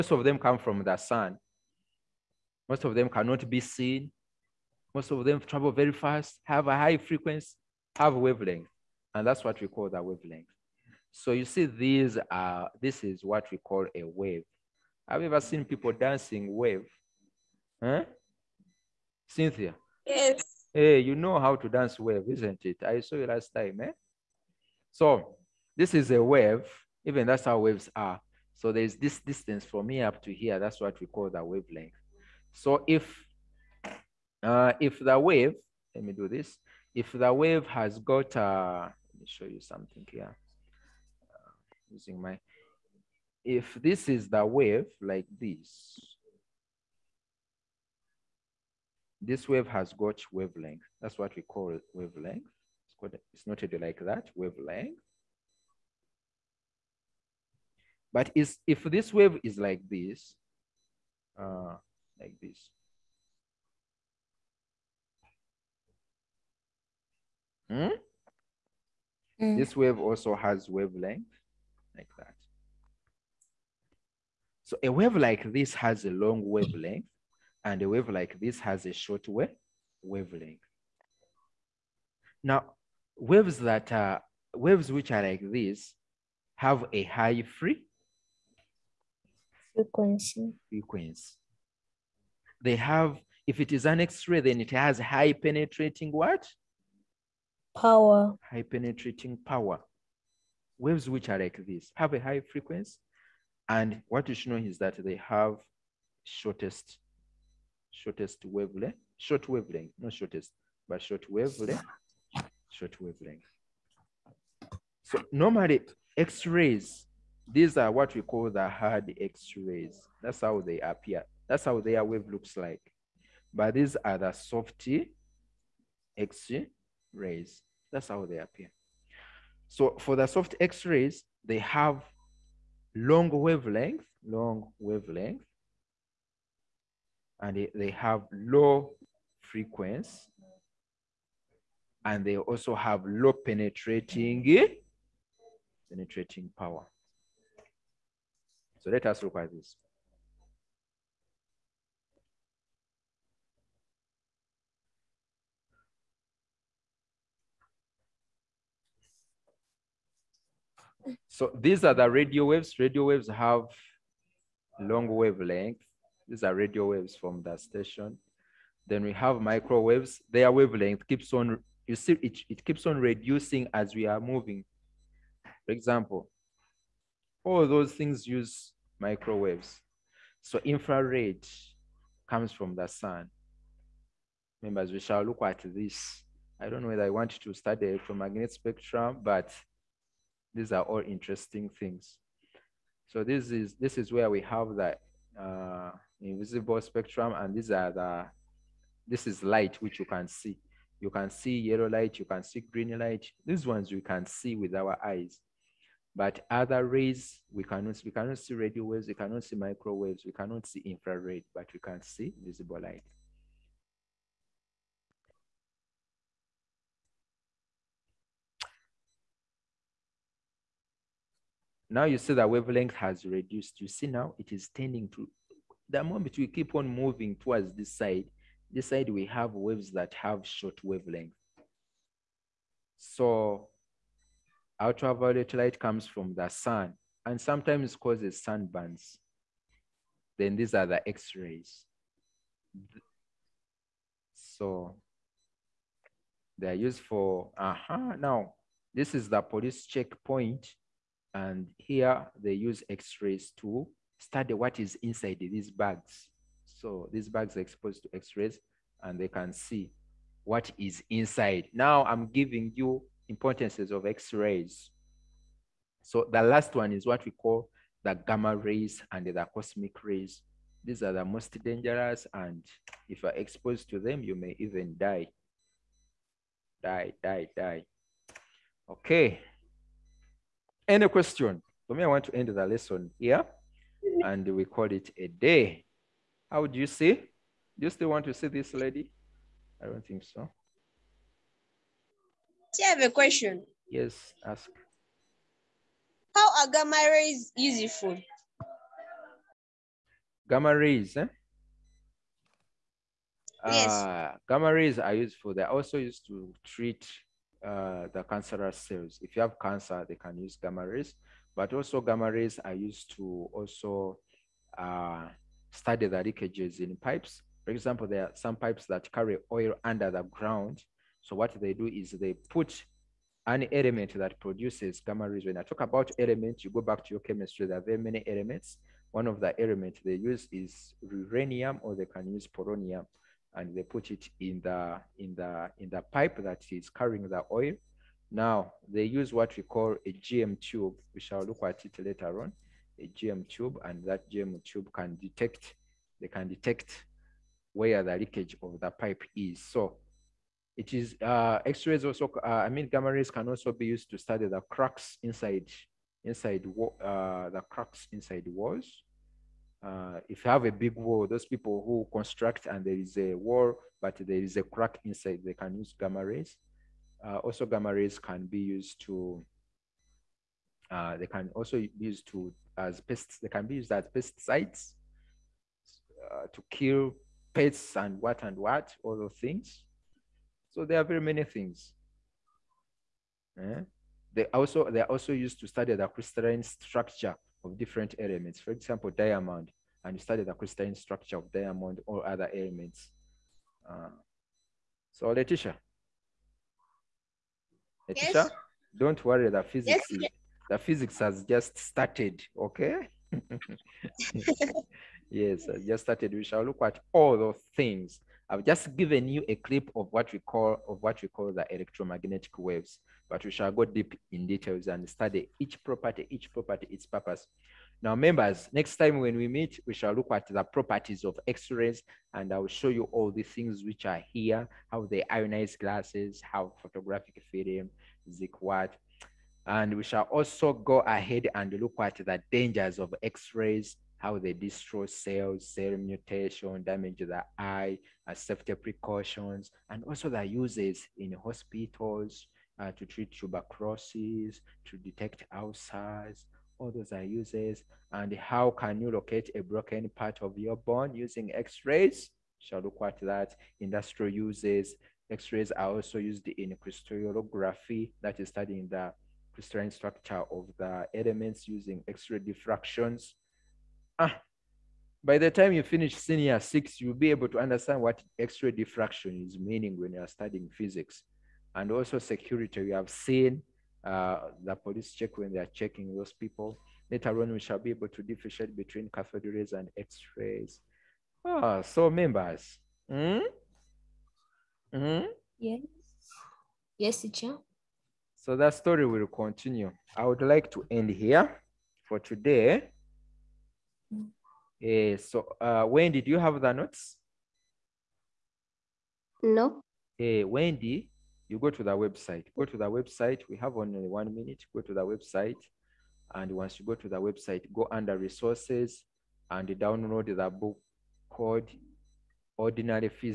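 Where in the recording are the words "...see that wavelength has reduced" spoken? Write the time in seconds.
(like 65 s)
222 s.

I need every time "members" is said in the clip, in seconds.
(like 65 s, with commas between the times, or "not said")
184 s, 418 s, 482 s.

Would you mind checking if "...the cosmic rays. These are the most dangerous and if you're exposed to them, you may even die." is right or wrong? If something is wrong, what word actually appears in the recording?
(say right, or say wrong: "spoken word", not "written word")
right.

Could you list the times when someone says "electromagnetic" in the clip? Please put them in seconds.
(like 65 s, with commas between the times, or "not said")
187 s, 411 s.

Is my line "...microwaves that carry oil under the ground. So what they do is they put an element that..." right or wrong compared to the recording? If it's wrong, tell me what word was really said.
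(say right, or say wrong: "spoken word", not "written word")
wrong: "pipes", not "microwaves".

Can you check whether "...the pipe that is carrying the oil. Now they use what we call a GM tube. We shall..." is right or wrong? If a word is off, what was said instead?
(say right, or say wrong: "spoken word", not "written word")
right.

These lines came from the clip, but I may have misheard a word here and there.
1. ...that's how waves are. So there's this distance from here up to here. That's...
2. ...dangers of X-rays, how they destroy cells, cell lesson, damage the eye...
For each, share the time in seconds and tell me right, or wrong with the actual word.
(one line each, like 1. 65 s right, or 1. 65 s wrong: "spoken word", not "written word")
1. 27 s right
2. 432 s wrong: "mutation", not "lesson".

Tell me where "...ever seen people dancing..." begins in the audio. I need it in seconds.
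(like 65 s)
15 s.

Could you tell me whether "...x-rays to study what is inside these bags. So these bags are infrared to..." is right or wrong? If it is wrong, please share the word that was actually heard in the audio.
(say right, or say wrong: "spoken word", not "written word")
wrong: "exposed", not "infrared".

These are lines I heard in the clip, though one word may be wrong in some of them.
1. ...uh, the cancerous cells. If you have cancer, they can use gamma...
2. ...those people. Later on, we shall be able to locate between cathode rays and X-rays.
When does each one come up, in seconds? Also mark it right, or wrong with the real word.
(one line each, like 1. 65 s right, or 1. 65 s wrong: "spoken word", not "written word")
1. 307 s right
2. 476 s wrong: "differentiate", not "locate".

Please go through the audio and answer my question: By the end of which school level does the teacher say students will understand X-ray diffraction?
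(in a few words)
senior six.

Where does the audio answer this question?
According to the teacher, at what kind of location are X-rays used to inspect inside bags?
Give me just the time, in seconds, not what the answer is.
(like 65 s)
249 s.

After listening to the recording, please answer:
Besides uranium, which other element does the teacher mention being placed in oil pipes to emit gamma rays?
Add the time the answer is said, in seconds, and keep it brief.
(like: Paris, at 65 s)
polonium, at 332 s.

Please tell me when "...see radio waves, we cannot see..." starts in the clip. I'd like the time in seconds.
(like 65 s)
208 s.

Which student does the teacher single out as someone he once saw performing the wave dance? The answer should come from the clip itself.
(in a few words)
Cynthia.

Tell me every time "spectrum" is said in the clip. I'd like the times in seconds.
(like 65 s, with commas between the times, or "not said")
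188 s, 196 s.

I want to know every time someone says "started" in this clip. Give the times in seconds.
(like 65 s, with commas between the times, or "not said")
401 s, 406 s.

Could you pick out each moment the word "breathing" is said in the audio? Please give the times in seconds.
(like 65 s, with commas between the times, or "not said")
not said.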